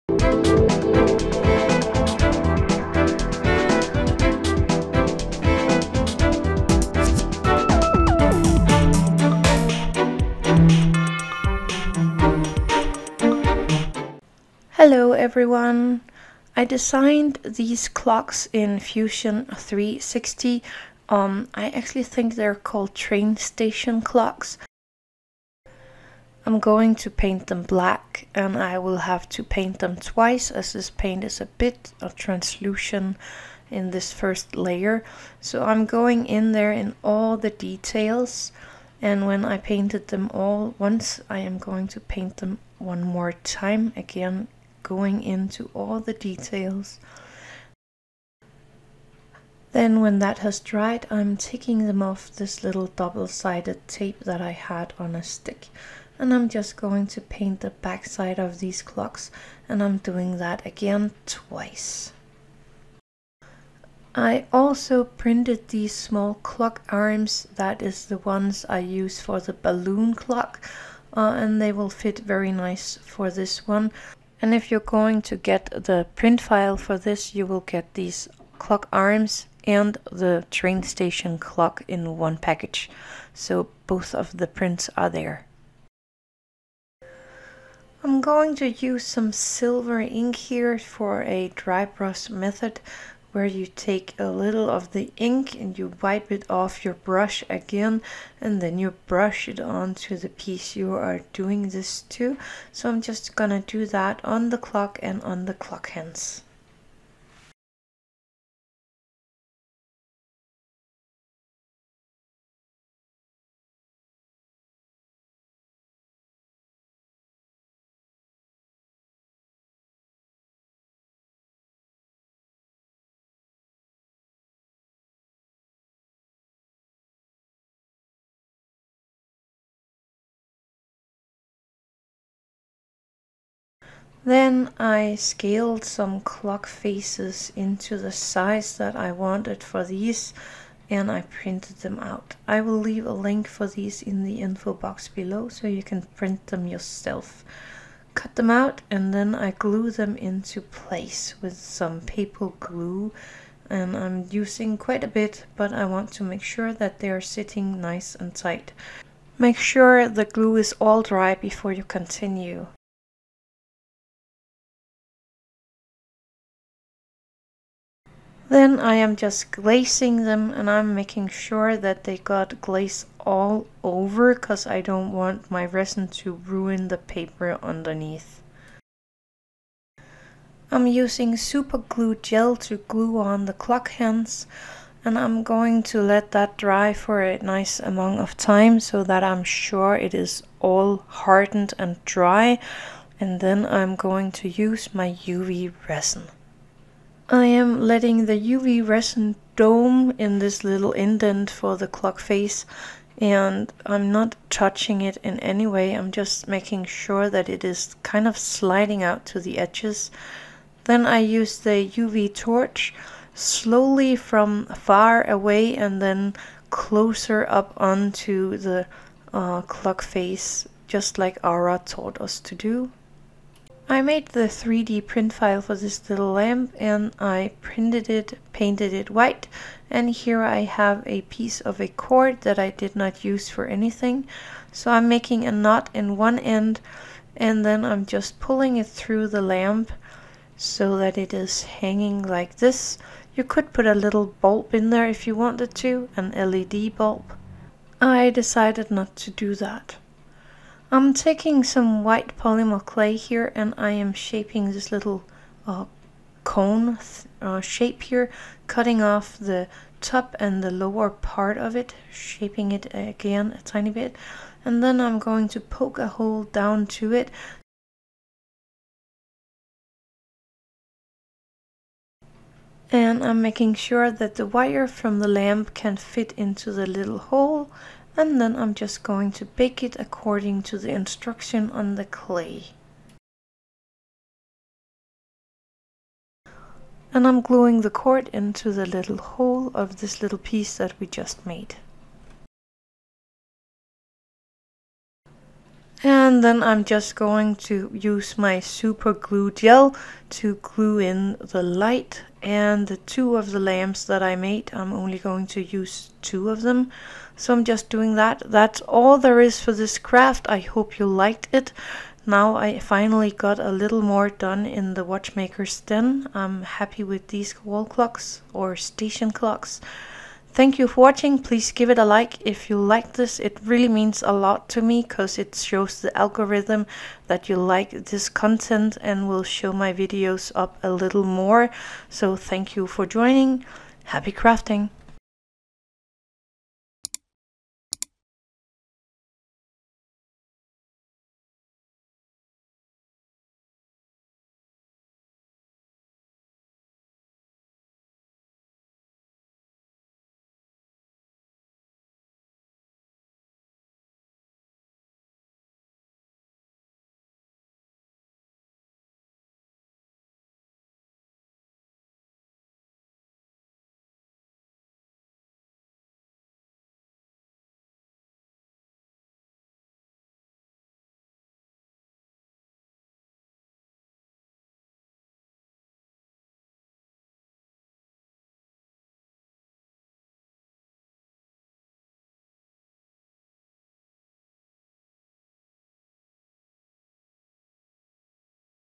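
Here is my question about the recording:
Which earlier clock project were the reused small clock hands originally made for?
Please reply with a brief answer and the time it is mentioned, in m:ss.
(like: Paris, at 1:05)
balloon clock, at 1:09.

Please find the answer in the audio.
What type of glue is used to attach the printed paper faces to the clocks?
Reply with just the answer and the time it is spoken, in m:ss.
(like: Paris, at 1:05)
paper glue, at 2:32.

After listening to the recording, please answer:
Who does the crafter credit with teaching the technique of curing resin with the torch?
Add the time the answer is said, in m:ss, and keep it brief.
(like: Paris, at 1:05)
Aura, at 3:41.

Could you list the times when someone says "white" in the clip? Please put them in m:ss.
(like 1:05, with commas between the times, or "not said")
3:49, 4:12.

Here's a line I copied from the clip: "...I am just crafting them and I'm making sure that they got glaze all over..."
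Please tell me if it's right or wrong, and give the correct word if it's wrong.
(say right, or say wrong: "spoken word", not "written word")
wrong: "glazing", not "crafting".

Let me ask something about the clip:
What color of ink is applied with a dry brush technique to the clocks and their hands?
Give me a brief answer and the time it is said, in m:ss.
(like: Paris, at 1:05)
silver, at 1:29.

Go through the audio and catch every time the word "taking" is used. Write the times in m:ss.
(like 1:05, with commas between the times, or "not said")
0:51, 4:11.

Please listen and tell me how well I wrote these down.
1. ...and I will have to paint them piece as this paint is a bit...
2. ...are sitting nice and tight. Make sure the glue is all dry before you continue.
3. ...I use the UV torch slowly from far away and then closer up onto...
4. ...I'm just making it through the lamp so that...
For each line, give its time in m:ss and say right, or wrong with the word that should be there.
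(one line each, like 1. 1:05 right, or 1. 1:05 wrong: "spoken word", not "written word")
1. 0:28 wrong: "twice", not "piece"
2. 2:37 right
3. 3:31 right
4. 3:57 wrong: "pulling", not "making".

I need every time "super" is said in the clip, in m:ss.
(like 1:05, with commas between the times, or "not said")
3:01, 4:58.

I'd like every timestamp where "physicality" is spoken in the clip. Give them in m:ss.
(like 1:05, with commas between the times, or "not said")
not said.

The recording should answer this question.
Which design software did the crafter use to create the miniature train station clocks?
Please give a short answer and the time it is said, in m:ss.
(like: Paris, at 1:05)
Fusion 360, at 0:18.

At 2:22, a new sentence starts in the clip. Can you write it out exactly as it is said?
I will leave a link for these in the info box below so you can print them yourself.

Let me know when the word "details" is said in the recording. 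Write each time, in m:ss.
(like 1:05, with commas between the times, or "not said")
0:37, 0:46.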